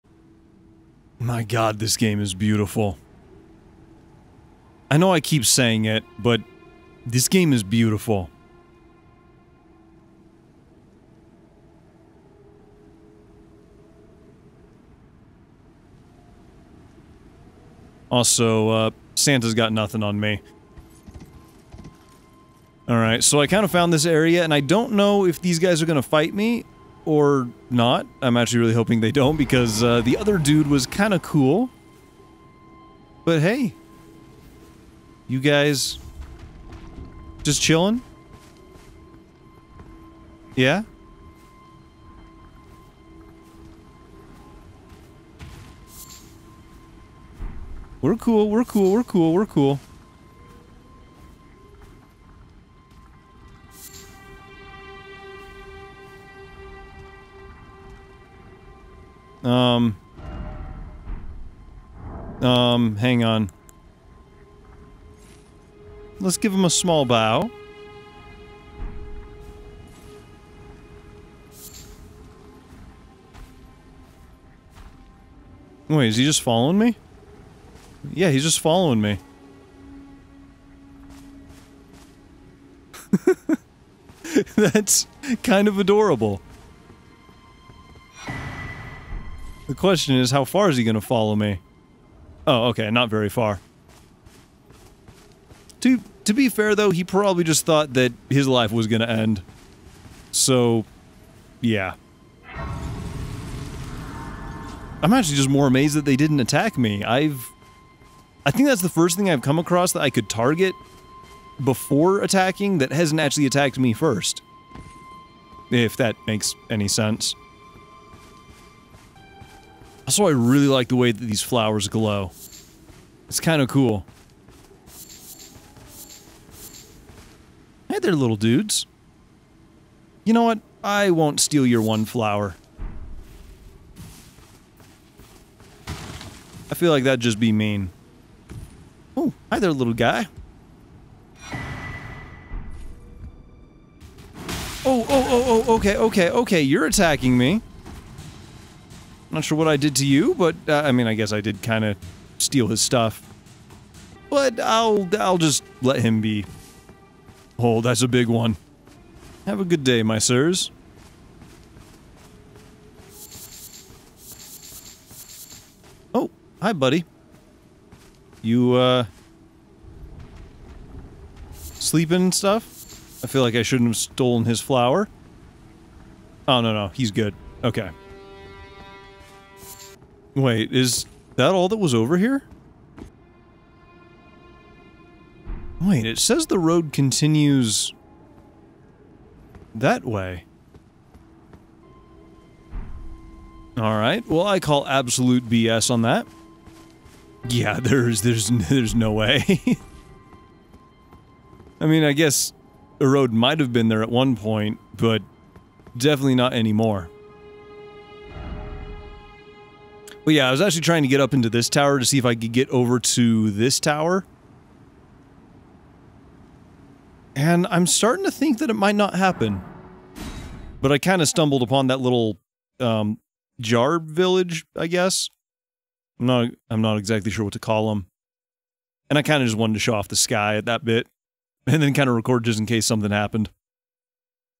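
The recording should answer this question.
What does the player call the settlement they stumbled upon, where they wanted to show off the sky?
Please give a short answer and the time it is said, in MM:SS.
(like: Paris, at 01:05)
jar village, at 03:43.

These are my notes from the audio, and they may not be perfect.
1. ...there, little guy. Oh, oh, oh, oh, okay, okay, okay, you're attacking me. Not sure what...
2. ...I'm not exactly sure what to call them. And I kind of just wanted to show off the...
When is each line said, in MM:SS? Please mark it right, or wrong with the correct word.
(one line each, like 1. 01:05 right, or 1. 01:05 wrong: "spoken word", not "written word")
1. 02:19 right
2. 03:46 right.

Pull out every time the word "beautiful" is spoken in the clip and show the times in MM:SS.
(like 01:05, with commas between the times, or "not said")
00:02, 00:07.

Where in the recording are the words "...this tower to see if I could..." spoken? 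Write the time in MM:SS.
03:31.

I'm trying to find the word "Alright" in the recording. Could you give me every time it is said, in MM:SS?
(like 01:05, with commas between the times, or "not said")
00:22, 03:13.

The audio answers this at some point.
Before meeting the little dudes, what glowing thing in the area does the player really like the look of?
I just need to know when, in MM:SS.
02:01.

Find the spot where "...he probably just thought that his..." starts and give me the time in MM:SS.
01:36.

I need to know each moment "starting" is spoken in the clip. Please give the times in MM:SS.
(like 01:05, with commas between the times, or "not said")
03:37.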